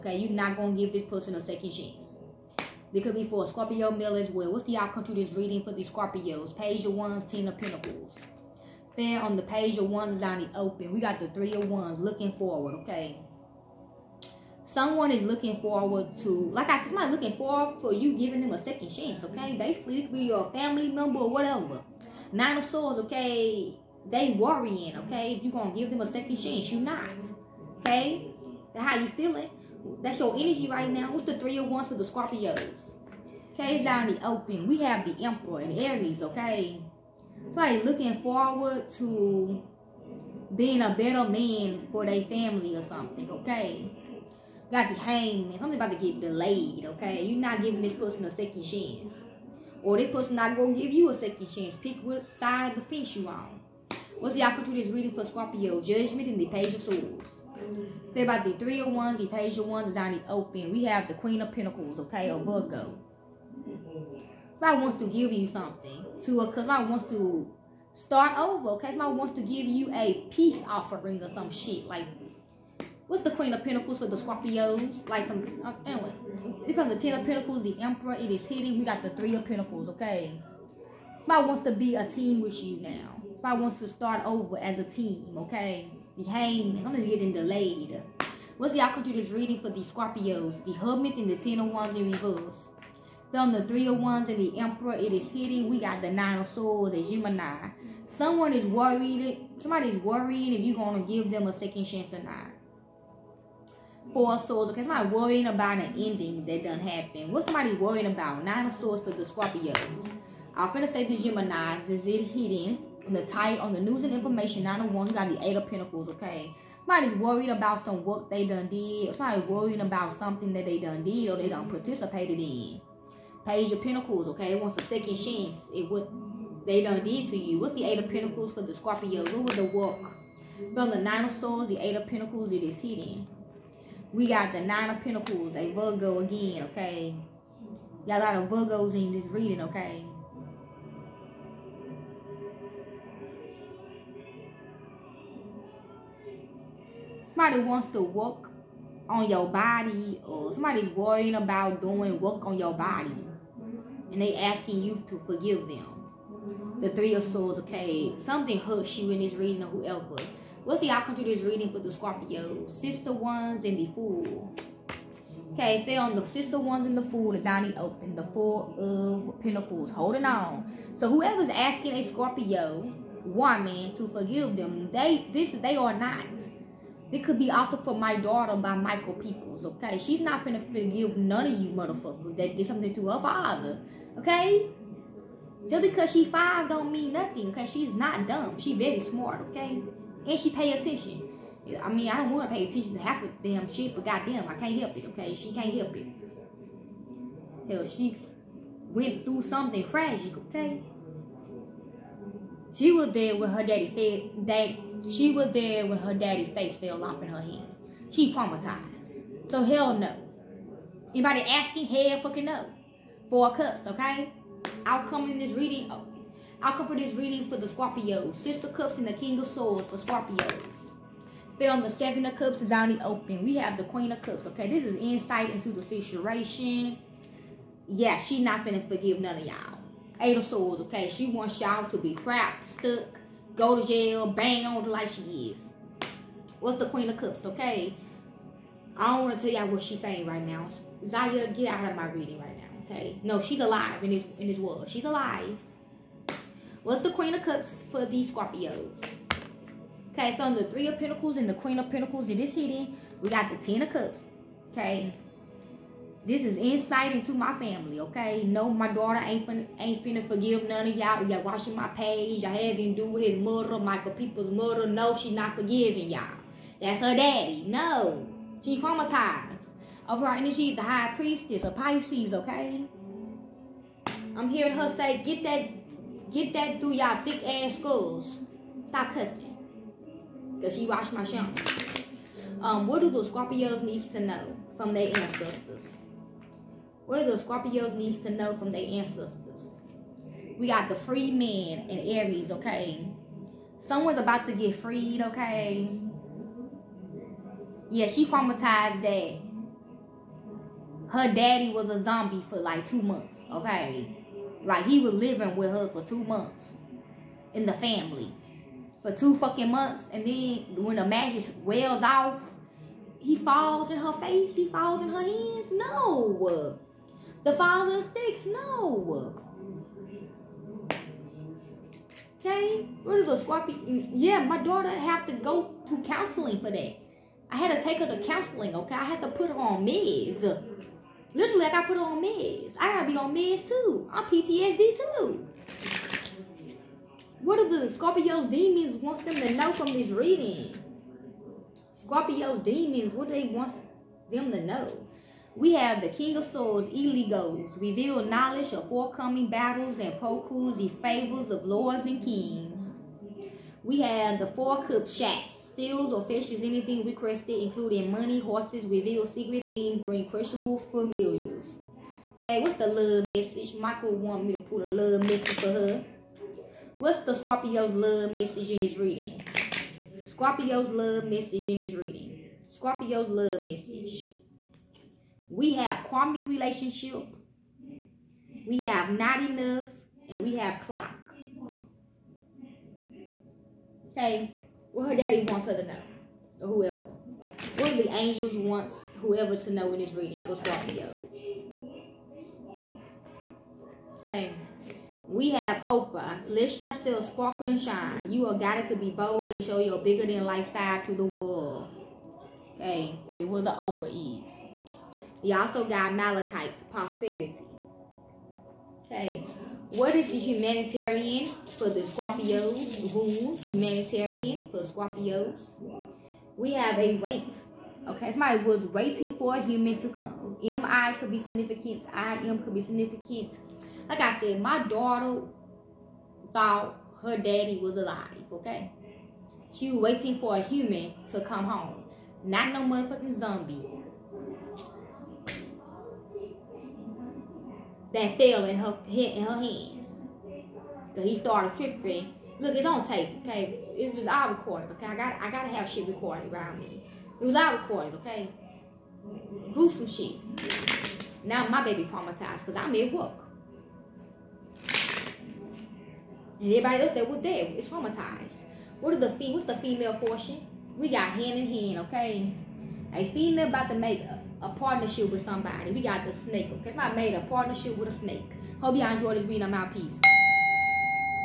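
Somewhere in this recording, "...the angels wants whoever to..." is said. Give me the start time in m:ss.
6:27.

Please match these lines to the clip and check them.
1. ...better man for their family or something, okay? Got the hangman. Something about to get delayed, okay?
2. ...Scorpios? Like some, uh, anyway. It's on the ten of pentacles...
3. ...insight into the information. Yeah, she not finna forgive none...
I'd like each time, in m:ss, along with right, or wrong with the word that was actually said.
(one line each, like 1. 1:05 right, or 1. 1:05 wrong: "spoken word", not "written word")
1. 0:40 right
2. 1:14 right
3. 3:44 wrong: "situation", not "information".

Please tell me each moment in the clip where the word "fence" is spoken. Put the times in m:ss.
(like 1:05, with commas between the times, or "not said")
0:52.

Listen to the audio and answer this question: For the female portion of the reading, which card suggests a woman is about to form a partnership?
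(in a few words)
Hand in hand.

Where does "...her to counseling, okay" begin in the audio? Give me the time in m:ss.
5:27.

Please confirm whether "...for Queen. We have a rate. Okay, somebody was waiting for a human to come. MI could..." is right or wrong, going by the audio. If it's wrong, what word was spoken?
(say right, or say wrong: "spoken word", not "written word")
wrong: "Scorpios", not "Queen".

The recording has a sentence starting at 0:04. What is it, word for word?
What's the outcome to this reading for the Scorpios?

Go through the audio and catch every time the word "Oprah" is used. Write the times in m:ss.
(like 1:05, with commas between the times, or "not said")
6:35, 6:43.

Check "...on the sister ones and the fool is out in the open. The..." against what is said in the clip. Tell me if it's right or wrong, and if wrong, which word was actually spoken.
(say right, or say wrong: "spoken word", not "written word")
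right.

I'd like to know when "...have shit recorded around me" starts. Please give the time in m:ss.
7:25.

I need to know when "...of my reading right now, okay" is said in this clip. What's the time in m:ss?
4:01.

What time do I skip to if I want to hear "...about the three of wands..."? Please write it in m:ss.
0:58.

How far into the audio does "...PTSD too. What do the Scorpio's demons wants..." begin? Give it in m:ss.
5:34.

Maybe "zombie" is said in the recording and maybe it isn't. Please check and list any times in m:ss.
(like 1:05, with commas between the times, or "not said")
5:02, 7:13.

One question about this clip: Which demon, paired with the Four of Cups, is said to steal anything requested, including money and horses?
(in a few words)
Shax.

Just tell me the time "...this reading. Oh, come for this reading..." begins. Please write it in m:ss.
3:35.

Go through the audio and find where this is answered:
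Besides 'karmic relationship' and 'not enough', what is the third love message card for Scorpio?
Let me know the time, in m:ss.
6:20.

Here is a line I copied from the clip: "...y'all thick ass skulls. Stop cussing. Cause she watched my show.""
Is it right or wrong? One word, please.
right.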